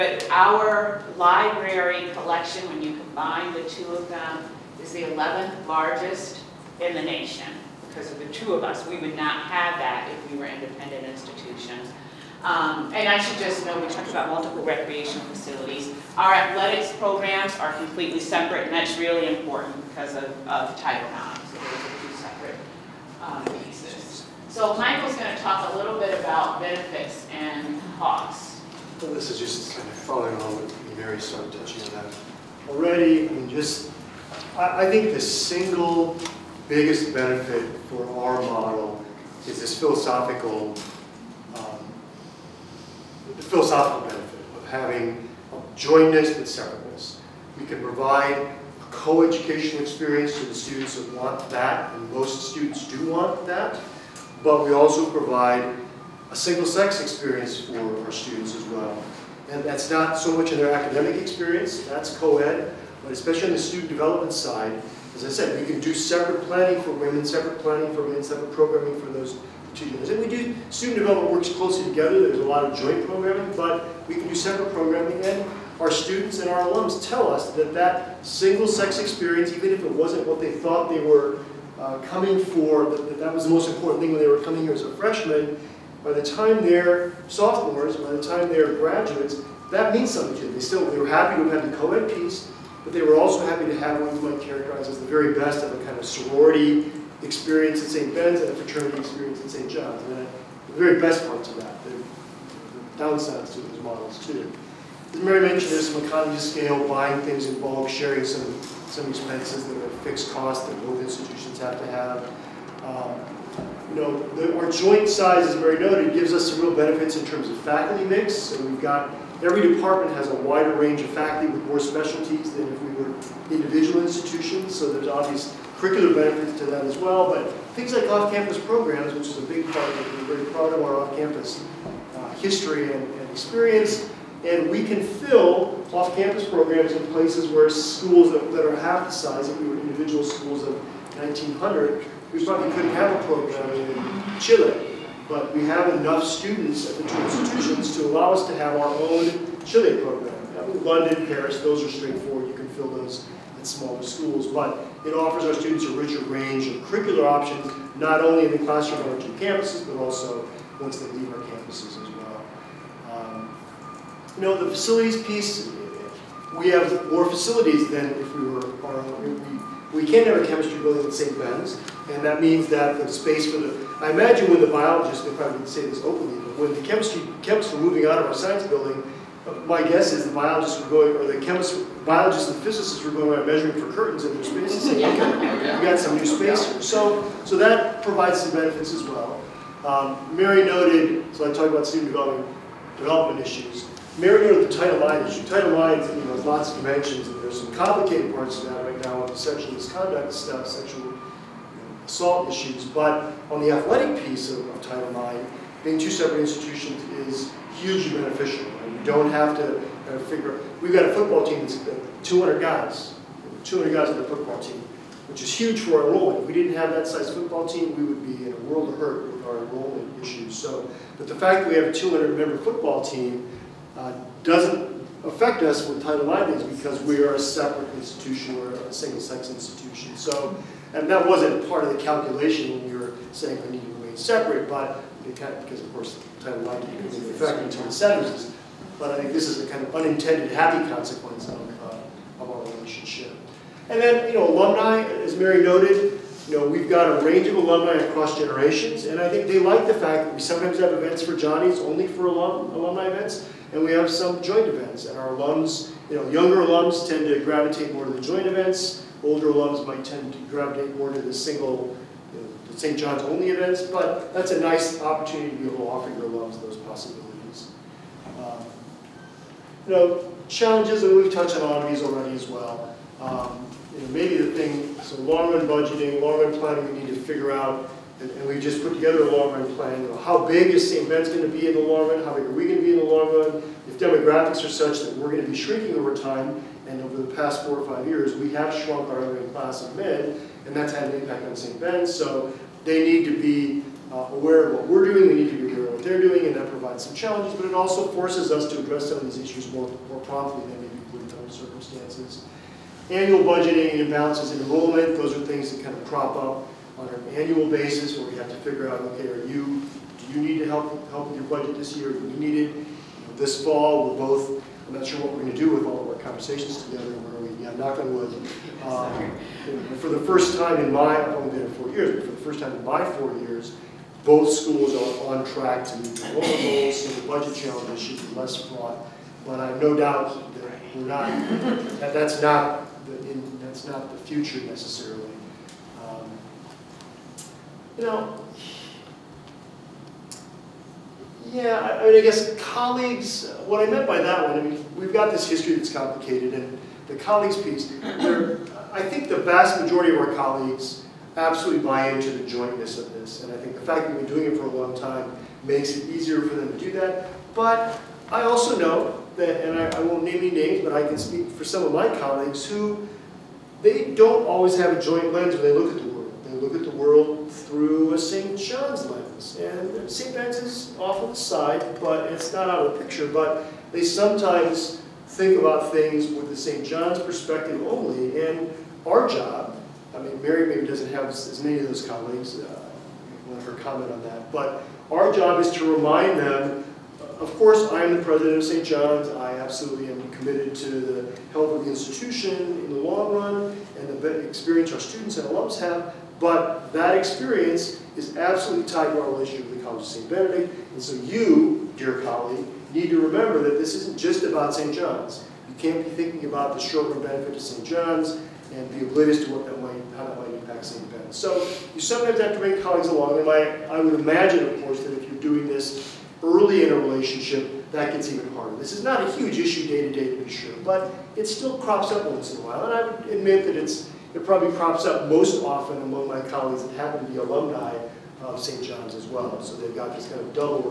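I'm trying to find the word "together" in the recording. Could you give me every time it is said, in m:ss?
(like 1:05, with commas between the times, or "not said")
1:11, 4:38, 5:16.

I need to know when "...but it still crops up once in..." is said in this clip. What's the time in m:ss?
7:00.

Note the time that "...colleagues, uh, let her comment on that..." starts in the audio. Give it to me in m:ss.
6:22.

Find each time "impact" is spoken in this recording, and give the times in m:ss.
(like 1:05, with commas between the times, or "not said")
4:51, 6:50.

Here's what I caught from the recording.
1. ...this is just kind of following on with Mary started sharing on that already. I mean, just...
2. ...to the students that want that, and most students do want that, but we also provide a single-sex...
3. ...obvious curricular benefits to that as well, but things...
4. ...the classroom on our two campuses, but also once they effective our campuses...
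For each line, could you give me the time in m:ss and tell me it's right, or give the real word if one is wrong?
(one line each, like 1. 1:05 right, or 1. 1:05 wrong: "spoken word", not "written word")
1. 0:29 wrong: "touching", not "sharing"
2. 0:50 right
3. 2:05 right
4. 2:38 wrong: "leave", not "effective".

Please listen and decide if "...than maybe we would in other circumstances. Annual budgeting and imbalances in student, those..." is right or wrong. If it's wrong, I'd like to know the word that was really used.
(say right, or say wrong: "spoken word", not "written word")
wrong: "enrollment", not "student".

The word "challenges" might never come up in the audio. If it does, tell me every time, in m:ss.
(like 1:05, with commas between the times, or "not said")
4:30, 4:57, 5:27.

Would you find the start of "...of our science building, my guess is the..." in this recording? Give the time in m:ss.
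2:58.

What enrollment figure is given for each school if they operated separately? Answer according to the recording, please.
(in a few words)
1900.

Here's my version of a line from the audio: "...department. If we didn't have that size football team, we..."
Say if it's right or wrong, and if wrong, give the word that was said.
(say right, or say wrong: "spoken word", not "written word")
wrong: "enrollment", not "department".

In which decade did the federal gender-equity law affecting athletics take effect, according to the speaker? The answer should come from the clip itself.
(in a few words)
the 70s.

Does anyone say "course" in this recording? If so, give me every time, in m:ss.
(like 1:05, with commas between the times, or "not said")
3:55, 6:27, 6:54.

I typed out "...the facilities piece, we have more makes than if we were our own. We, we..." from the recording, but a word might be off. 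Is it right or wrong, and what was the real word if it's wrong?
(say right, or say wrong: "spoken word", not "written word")
wrong: "facilities", not "makes".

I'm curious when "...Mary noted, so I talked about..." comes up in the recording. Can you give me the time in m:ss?
3:10.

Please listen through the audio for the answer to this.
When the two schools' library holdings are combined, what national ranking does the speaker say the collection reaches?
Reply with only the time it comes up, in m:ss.
0:05.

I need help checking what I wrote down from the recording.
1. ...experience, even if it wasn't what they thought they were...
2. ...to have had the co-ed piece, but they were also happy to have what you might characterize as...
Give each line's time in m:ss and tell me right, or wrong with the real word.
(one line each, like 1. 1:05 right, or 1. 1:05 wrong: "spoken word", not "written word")
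1. 1:18 right
2. 1:31 right.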